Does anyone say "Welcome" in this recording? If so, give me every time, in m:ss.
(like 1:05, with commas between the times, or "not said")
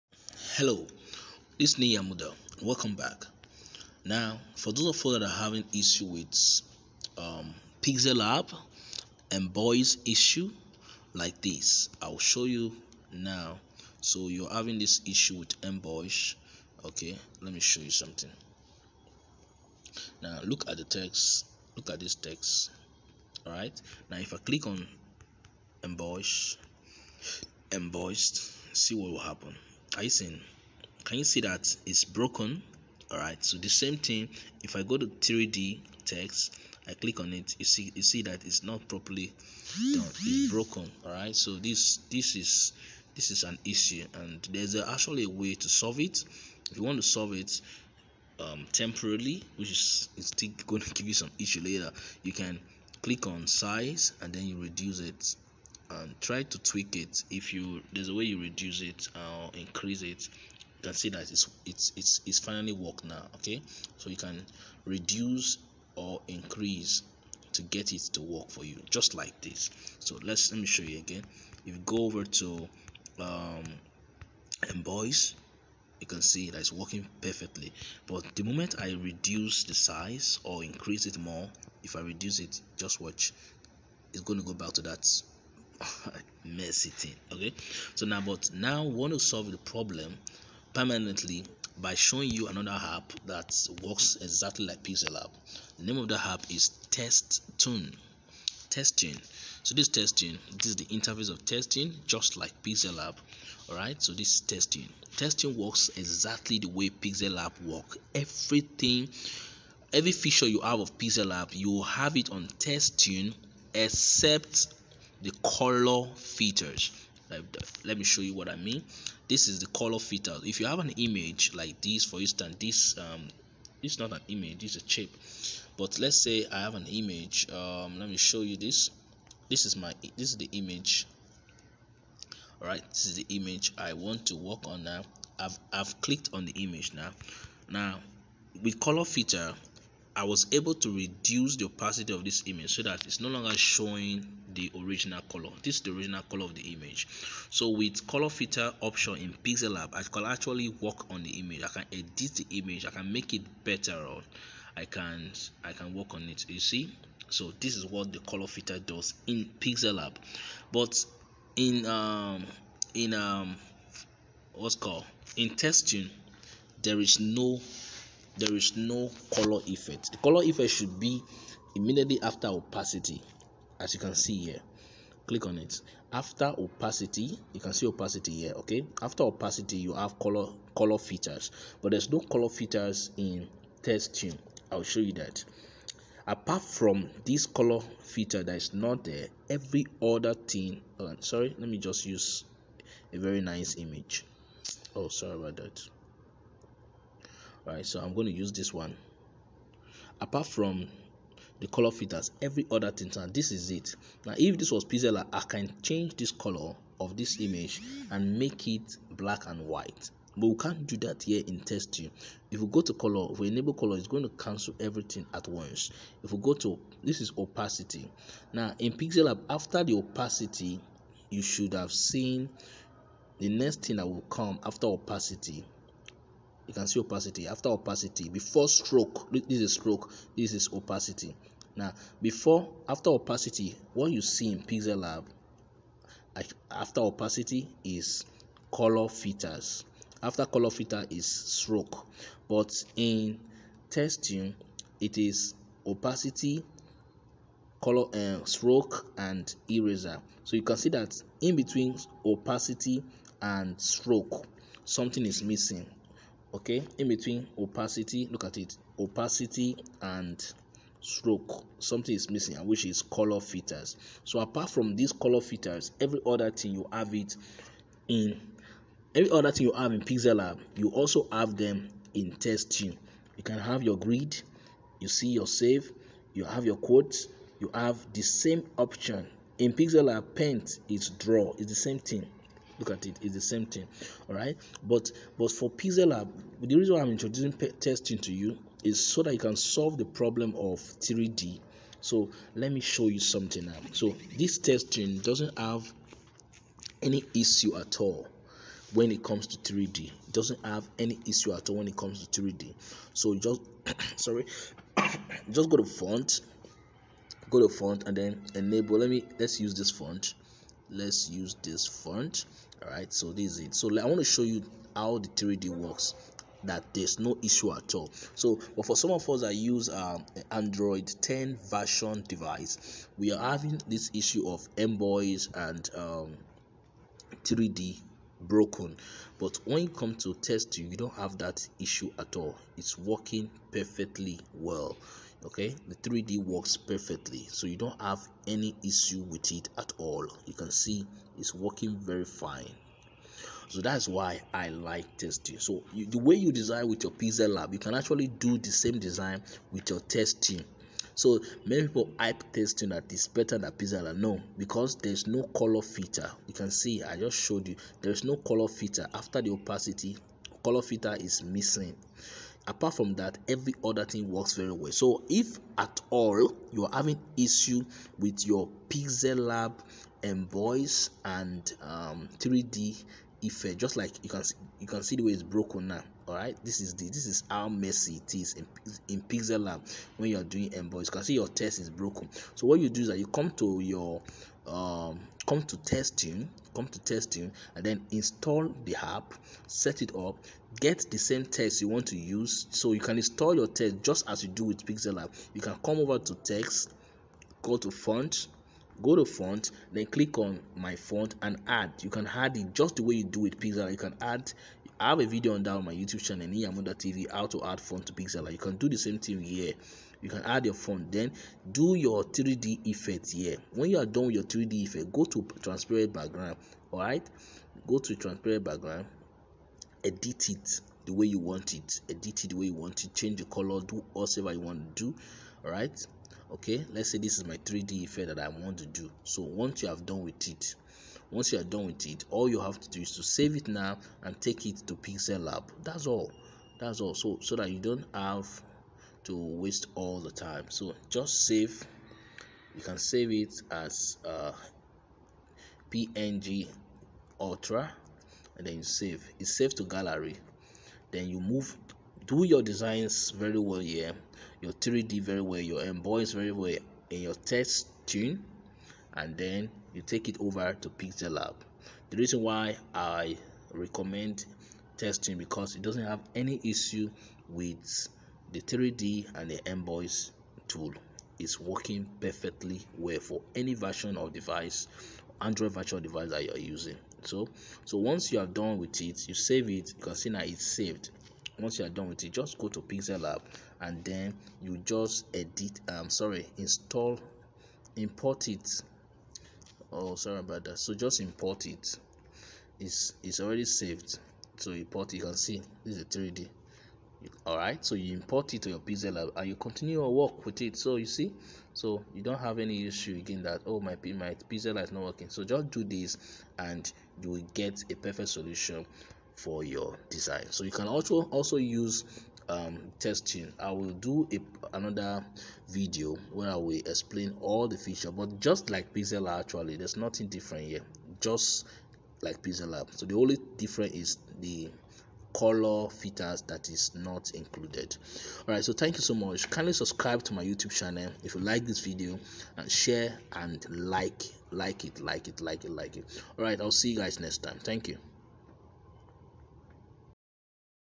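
0:02.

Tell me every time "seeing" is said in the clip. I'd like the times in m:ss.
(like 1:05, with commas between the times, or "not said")
0:30.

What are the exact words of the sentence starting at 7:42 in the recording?
The reason why I recommend Textoon because it doesn't have any issue with the 3D and the Emboss tool.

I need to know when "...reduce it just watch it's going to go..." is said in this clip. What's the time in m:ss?
1:21.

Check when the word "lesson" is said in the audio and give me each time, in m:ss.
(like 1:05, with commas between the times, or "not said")
not said.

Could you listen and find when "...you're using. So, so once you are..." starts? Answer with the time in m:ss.
7:56.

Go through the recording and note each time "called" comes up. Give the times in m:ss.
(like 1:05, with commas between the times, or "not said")
2:44.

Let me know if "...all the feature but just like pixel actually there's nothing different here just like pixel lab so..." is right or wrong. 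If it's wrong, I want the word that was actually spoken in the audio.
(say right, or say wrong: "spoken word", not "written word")
right.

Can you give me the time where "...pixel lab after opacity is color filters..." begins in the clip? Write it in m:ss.
3:54.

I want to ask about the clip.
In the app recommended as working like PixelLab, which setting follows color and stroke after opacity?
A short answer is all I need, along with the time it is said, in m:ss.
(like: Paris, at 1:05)
Eraser, at 4:08.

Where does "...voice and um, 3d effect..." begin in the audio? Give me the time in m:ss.
6:10.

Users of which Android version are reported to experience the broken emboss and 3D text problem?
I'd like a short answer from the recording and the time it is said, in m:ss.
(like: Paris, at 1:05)
Android 10, at 5:20.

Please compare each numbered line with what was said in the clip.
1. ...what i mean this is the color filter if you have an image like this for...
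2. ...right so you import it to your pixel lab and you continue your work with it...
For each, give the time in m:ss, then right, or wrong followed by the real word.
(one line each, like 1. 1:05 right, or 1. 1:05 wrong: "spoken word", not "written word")
1. 1:58 right
2. 8:17 right.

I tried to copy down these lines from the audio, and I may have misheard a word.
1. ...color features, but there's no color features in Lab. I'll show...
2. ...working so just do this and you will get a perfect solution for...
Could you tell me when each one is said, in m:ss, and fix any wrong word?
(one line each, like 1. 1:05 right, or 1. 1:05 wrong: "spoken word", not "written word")
1. 3:00 wrong: "Textoon", not "Lab"
2. 8:25 right.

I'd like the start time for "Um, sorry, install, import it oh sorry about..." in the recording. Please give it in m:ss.
8:05.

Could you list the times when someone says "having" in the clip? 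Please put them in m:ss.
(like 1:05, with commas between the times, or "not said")
0:05, 0:14, 5:23, 6:06.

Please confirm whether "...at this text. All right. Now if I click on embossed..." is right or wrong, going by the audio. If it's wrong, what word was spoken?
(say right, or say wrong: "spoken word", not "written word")
right.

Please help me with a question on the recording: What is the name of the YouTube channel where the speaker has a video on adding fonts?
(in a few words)
Niyi Amuda.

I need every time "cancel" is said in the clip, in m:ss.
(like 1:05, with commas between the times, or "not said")
3:34.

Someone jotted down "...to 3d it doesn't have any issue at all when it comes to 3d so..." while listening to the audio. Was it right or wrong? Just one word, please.
right.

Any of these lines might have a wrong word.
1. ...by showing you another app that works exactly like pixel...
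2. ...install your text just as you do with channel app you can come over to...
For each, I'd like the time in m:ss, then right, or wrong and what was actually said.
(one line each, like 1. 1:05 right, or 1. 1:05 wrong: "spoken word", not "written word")
1. 1:31 right
2. 6:33 wrong: "pixel", not "channel".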